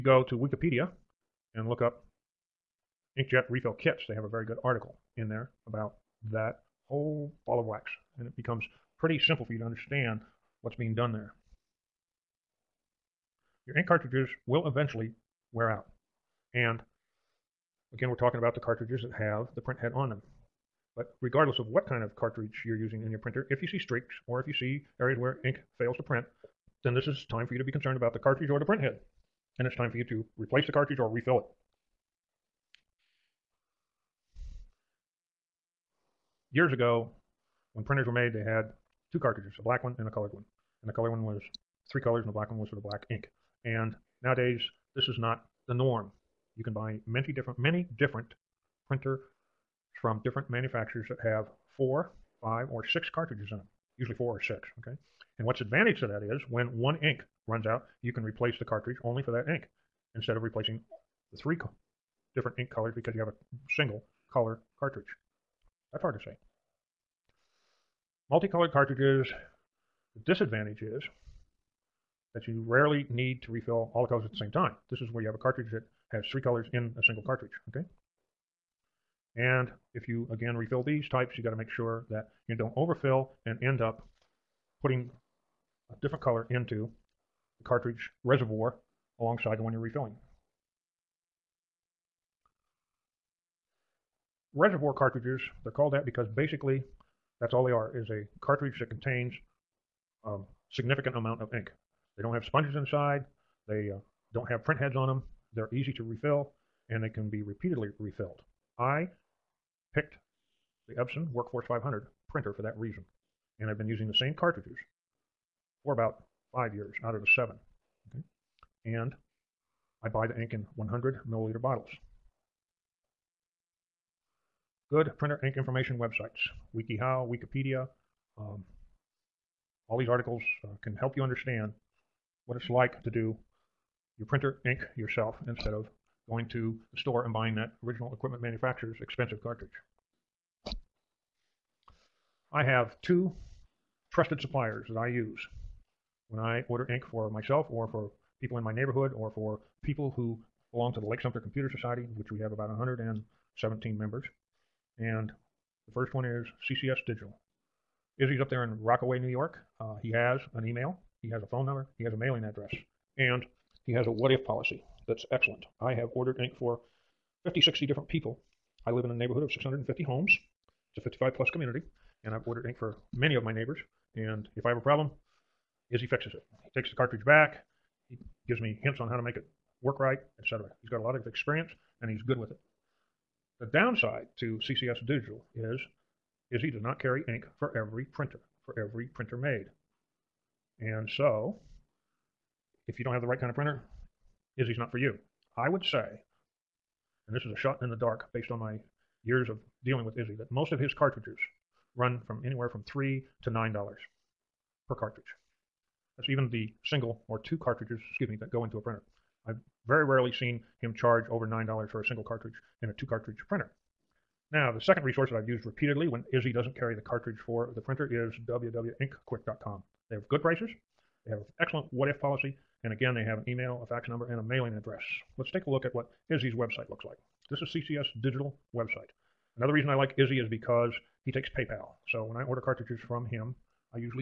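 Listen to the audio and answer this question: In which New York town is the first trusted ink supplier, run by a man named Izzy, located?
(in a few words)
Rockaway.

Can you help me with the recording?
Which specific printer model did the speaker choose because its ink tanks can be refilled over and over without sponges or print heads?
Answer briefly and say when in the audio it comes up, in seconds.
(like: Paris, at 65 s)
Epson Workforce 500, at 110 s.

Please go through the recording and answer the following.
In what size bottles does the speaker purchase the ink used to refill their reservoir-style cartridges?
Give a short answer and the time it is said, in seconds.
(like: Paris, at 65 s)
100 milliliters, at 120 s.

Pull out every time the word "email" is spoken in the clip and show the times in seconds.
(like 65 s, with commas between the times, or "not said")
160 s, 223 s.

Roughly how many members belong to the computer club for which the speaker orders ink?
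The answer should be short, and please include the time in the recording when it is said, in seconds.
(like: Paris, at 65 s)
117, at 152 s.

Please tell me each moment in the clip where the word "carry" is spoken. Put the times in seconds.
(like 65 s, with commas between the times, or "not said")
186 s, 216 s.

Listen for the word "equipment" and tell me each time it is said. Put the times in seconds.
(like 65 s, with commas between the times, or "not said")
138 s.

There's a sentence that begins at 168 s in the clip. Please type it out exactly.
I live in a neighborhood of 650 homes.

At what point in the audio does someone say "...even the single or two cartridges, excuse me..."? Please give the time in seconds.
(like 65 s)
206 s.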